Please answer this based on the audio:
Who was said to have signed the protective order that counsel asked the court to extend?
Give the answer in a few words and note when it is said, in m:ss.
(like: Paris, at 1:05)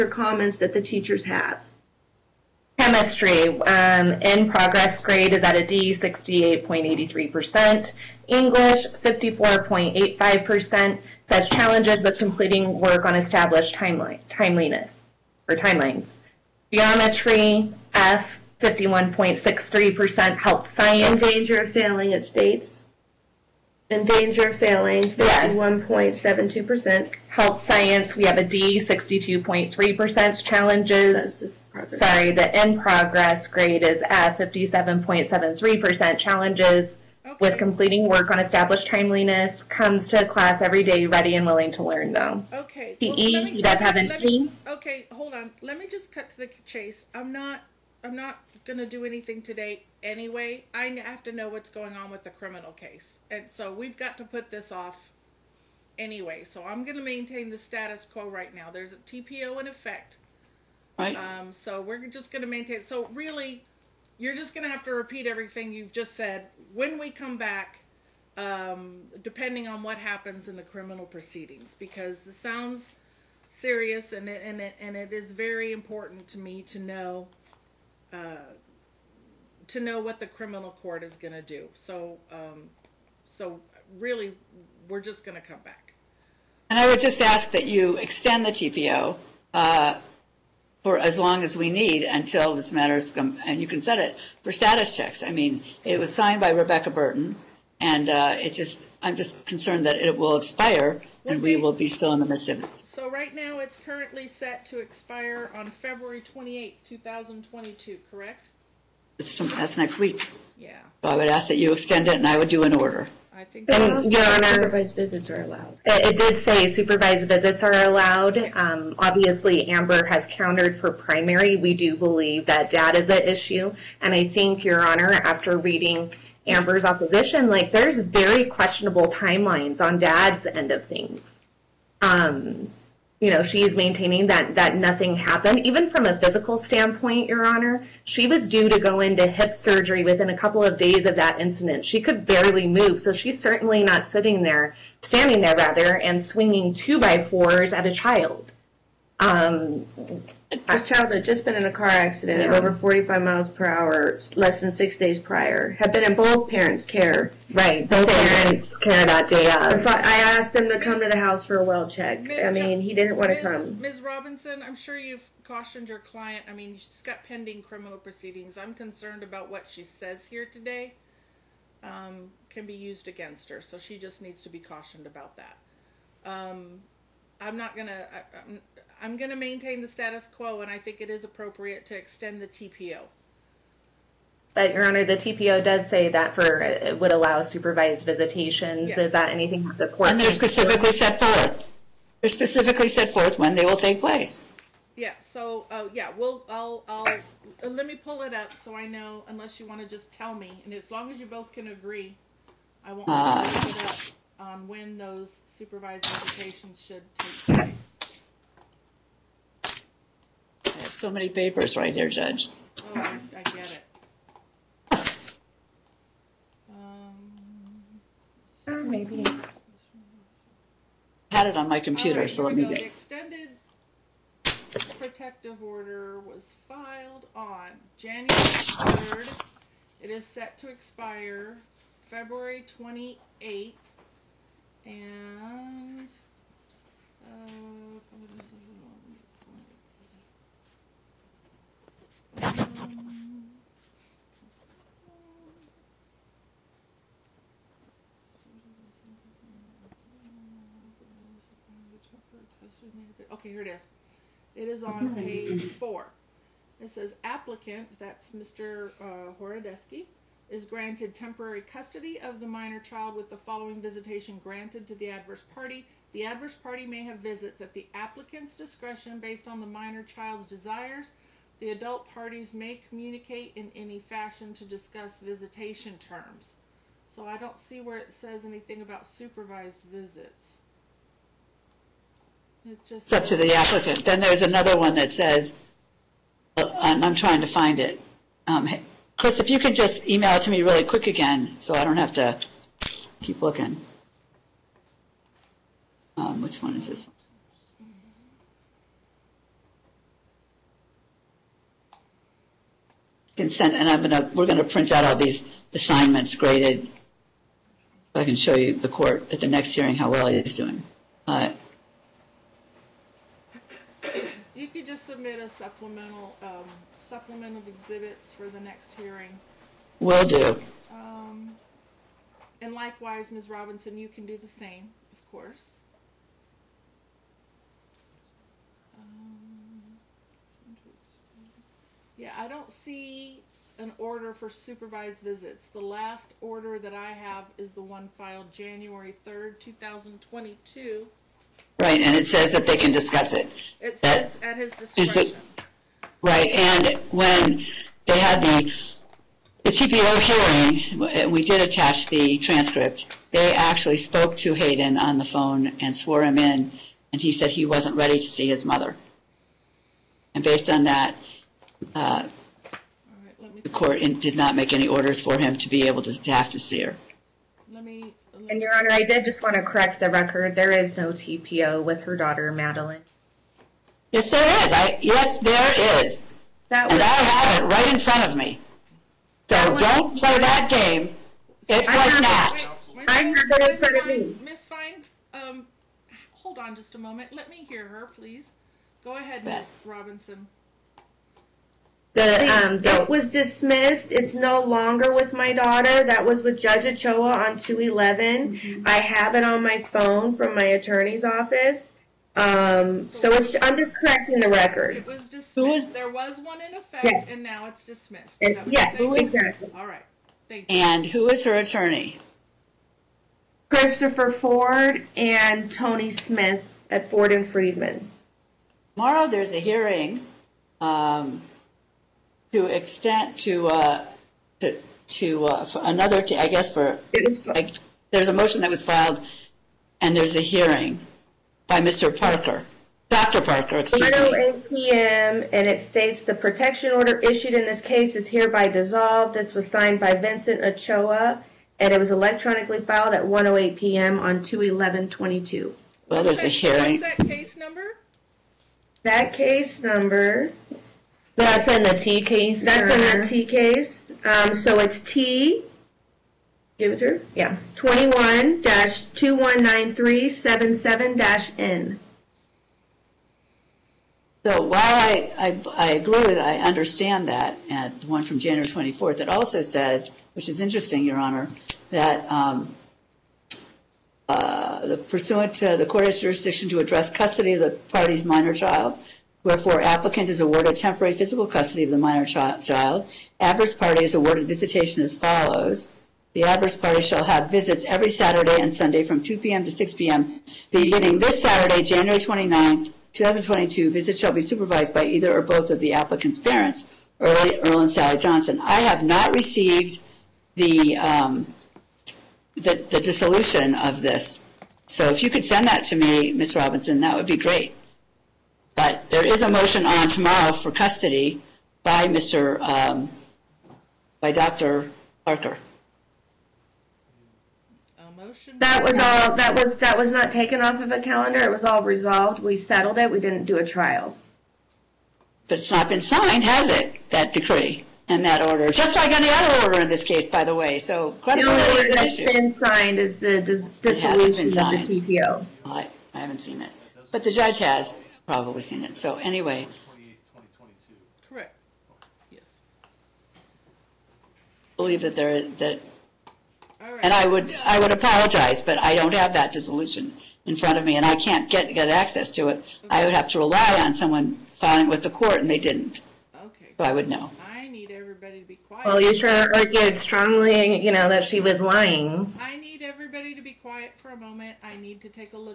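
Rebecca Burton, at 1:36.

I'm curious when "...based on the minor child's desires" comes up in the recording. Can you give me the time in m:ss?
4:29.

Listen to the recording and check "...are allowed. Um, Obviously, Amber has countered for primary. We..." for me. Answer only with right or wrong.
right.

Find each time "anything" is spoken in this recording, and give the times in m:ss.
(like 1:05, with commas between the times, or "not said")
0:49, 3:09, 4:38.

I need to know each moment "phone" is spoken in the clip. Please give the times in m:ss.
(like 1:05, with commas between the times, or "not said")
5:55, 6:39.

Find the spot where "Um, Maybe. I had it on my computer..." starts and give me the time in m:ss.
3:36.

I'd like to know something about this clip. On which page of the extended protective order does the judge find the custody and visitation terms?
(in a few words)
4.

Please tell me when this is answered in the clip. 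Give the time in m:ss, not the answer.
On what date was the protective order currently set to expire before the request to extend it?
1:45.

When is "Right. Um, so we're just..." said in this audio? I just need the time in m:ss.
1:00.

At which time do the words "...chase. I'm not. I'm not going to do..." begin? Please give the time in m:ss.
0:46.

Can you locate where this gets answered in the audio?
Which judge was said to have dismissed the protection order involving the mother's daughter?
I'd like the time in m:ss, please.
6:36.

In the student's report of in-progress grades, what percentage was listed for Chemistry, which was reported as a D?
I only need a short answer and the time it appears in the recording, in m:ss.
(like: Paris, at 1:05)
68.83%, at 0:05.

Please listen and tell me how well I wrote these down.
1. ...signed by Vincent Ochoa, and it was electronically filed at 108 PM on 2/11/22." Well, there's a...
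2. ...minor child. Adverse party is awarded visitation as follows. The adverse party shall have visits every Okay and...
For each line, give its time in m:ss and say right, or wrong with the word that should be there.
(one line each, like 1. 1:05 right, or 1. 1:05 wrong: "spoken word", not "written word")
1. 7:19 right
2. 8:01 wrong: "Saturday", not "Okay".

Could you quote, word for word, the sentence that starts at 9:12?
I would have to rely on someone filing with the court, and they didn't, Okay.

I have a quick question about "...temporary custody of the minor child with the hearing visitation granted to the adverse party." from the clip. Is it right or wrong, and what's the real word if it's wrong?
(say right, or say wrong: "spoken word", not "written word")
wrong: "following", not "hearing".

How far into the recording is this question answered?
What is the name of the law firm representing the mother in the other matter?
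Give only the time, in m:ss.
6:57.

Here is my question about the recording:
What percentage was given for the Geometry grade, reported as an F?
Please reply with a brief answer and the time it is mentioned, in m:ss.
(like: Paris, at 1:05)
51.63%, at 0:18.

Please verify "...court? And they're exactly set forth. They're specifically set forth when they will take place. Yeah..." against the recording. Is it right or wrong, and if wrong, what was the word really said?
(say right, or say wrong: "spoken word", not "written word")
wrong: "specifically", not "exactly".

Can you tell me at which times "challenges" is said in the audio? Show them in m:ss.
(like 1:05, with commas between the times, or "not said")
0:11, 0:30, 0:36.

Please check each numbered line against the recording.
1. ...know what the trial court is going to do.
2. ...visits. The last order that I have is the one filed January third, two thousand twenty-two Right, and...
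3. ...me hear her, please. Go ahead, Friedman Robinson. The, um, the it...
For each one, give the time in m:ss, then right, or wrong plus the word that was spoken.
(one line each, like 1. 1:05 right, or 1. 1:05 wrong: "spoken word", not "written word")
1. 1:19 wrong: "criminal", not "trial"
2. 5:35 right
3. 6:27 wrong: "Miss", not "Friedman".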